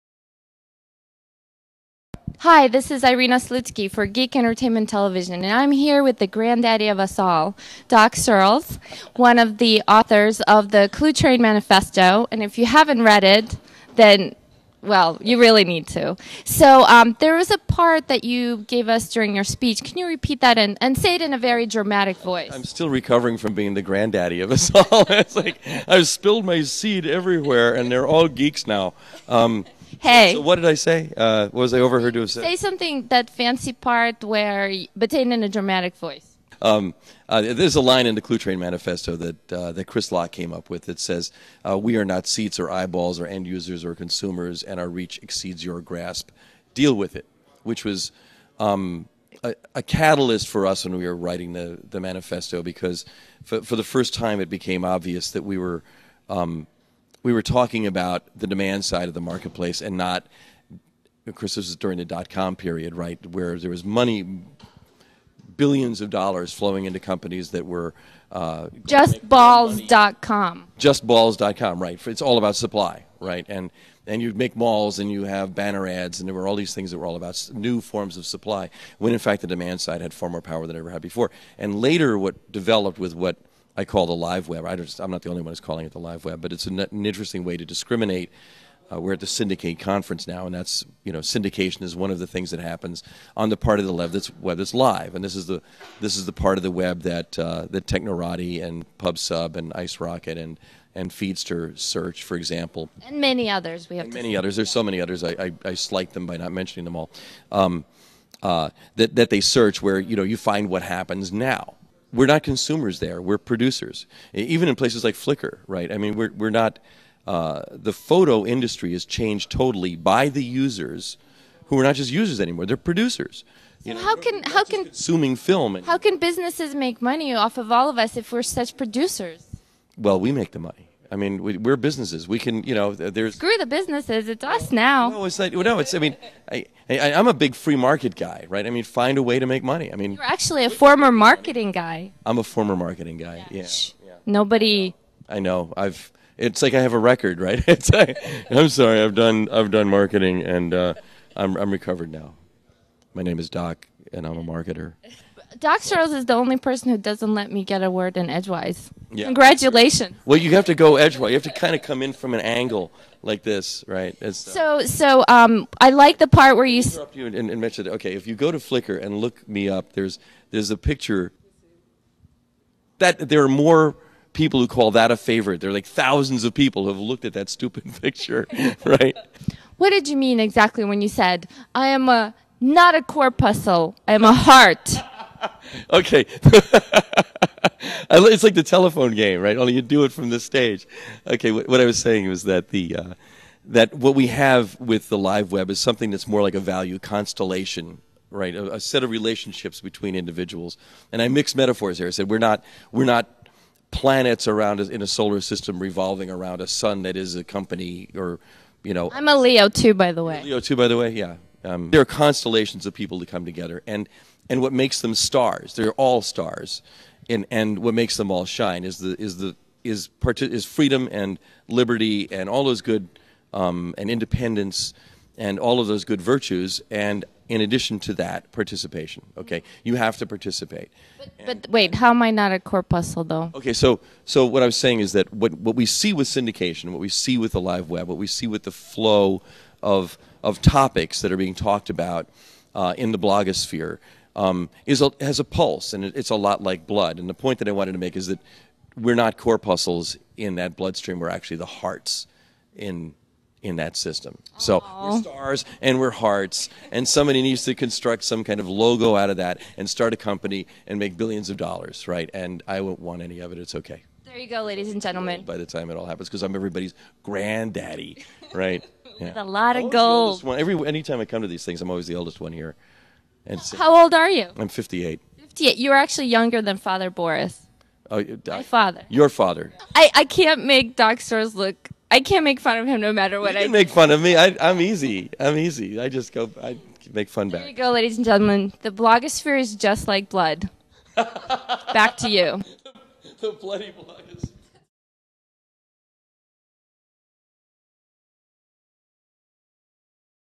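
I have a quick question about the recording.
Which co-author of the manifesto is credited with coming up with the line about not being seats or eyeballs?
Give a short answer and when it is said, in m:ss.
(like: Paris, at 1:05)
Chris Locke, at 0:39.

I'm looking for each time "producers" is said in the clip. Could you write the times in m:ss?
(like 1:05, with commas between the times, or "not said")
1:53, 2:02, 2:08.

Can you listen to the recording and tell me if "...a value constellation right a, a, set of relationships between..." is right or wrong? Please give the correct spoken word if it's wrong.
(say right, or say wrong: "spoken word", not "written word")
right.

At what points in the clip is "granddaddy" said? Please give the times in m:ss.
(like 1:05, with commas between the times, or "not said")
0:06, 0:23, 4:27.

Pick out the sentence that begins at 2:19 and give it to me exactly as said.
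I mean, you're actually a former marketing guy.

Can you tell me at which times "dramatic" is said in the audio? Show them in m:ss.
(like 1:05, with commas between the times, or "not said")
0:21, 0:35.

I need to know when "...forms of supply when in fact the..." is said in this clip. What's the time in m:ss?
1:17.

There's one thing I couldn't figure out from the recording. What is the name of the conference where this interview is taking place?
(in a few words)
Syndicate.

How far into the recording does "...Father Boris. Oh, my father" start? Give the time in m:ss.
4:36.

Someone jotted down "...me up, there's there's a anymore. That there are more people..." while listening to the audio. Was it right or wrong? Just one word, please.
wrong.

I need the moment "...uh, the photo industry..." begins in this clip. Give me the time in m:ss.
1:57.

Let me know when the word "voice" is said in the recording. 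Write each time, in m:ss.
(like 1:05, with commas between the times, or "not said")
0:22, 0:35.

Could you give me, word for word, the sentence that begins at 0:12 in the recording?
And if you haven't read it, then well, you really need to.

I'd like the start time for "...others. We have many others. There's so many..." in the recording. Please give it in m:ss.
1:43.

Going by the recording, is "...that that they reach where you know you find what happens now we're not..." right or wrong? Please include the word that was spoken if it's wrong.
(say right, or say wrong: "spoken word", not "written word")
wrong: "search", not "reach".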